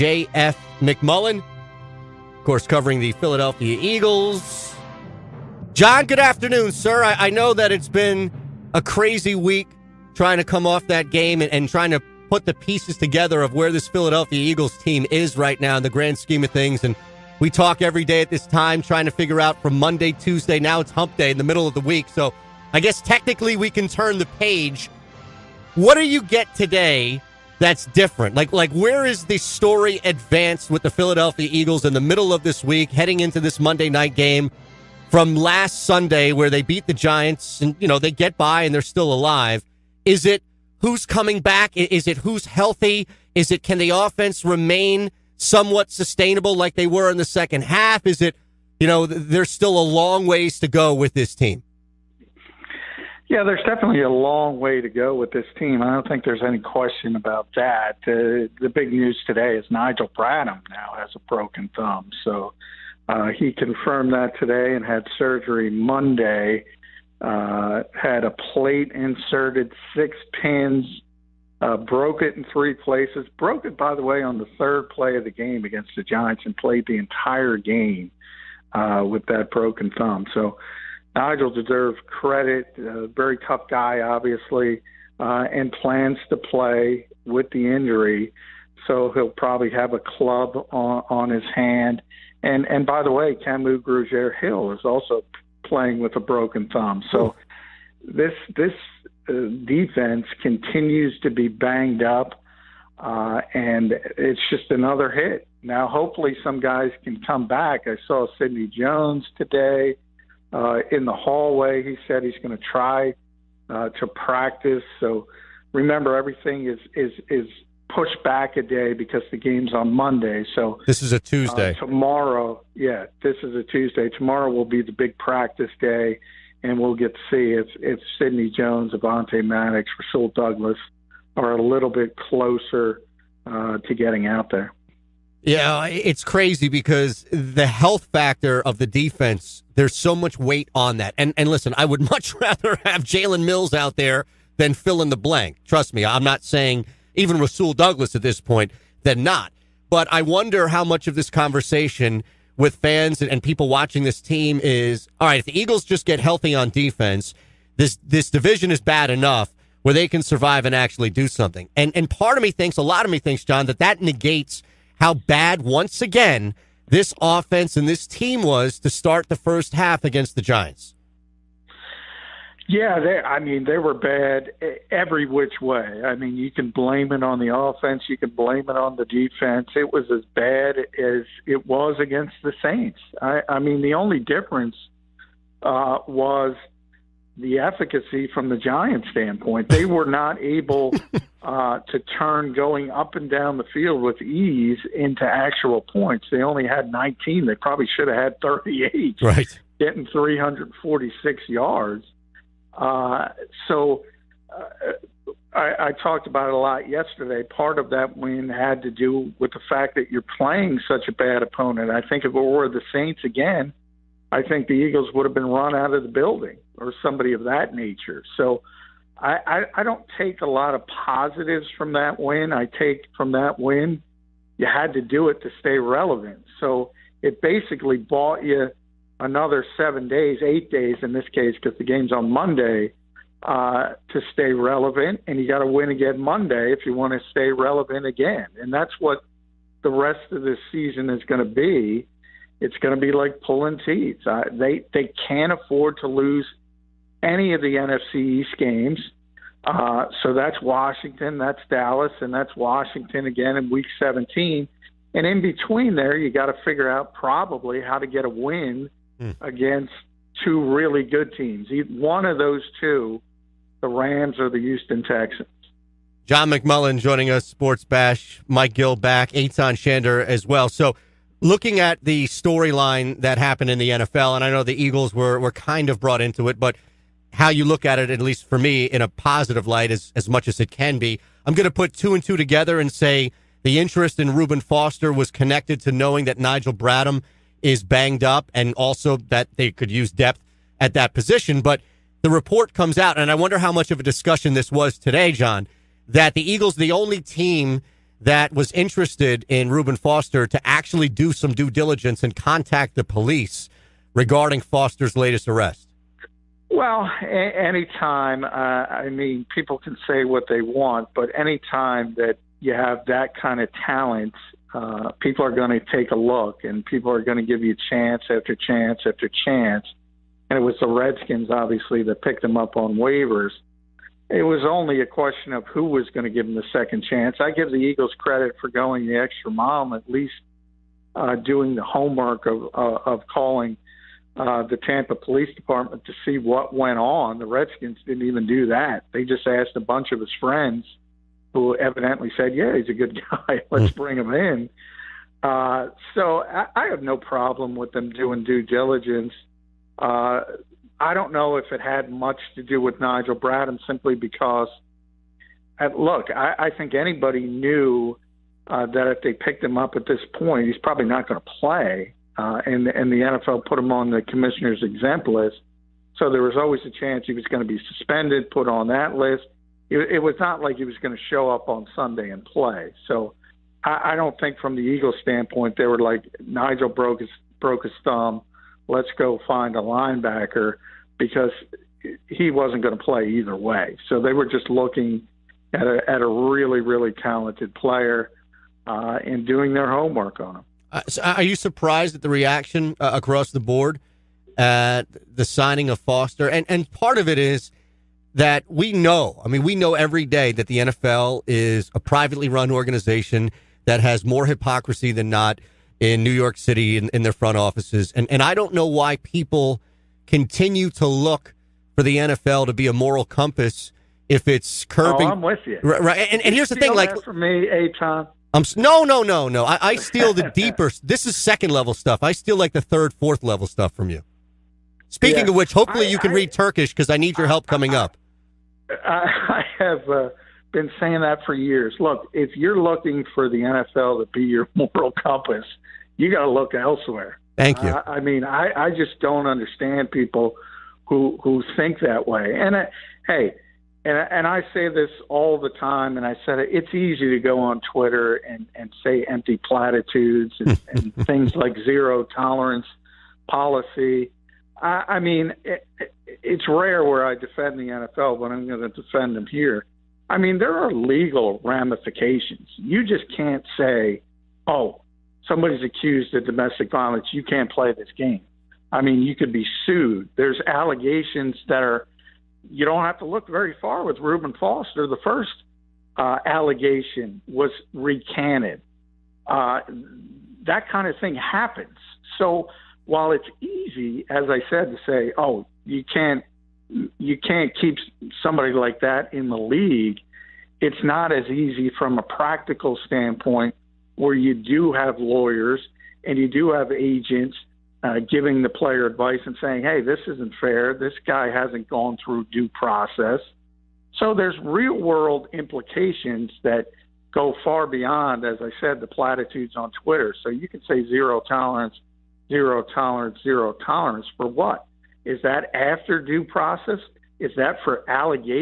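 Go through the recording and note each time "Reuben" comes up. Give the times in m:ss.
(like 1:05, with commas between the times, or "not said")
4:44, 4:59, 7:54.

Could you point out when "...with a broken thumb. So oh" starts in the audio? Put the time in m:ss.
1:35.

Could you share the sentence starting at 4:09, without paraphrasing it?
Uh, so that's Washington, that's Dallas, and that's Washington again in Week 17.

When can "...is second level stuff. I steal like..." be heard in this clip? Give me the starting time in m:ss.
7:01.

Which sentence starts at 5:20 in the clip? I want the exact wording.
And it was the Redskins, obviously, that picked him up on waivers.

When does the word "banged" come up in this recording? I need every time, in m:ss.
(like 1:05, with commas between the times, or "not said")
1:41, 4:47.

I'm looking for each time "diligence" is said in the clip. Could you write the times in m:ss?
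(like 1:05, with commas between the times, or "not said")
5:01, 5:48.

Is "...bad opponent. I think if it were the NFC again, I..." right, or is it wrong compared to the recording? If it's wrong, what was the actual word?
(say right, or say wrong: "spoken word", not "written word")
wrong: "Saints", not "NFC".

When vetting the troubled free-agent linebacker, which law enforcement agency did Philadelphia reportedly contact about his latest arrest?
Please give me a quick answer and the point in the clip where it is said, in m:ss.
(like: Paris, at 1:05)
Tampa Police Department, at 5:34.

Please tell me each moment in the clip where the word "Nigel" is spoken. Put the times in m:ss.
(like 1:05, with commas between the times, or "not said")
0:59, 1:21, 4:46, 5:53, 6:16.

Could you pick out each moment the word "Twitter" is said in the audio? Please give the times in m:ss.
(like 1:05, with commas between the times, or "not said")
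7:27, 8:30.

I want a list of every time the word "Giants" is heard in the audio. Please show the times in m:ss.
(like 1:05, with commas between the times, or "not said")
0:36, 1:16, 2:50, 3:08.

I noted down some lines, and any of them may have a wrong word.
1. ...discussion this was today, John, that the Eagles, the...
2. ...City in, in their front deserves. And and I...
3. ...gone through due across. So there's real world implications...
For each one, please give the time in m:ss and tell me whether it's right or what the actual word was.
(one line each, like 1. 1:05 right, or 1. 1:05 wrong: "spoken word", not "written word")
1. 4:54 right
2. 6:46 wrong: "offices", not "deserves"
3. 8:21 wrong: "process", not "across".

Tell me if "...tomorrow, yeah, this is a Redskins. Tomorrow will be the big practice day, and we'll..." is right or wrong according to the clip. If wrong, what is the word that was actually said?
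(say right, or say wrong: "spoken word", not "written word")
wrong: "Tuesday", not "Redskins".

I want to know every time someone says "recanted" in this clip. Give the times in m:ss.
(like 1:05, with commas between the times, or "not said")
7:57.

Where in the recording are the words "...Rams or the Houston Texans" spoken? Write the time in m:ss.
4:23.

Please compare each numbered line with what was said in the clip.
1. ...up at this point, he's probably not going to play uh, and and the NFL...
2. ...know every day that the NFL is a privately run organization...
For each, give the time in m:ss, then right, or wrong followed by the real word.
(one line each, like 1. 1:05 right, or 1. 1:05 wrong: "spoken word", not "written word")
1. 5:59 right
2. 6:39 right.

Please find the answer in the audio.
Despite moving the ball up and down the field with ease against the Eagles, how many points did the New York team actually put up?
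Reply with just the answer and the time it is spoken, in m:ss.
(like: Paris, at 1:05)
19, at 3:16.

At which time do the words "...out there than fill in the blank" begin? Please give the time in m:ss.
2:23.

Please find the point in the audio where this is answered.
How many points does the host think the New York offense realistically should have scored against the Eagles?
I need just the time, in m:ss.
3:18.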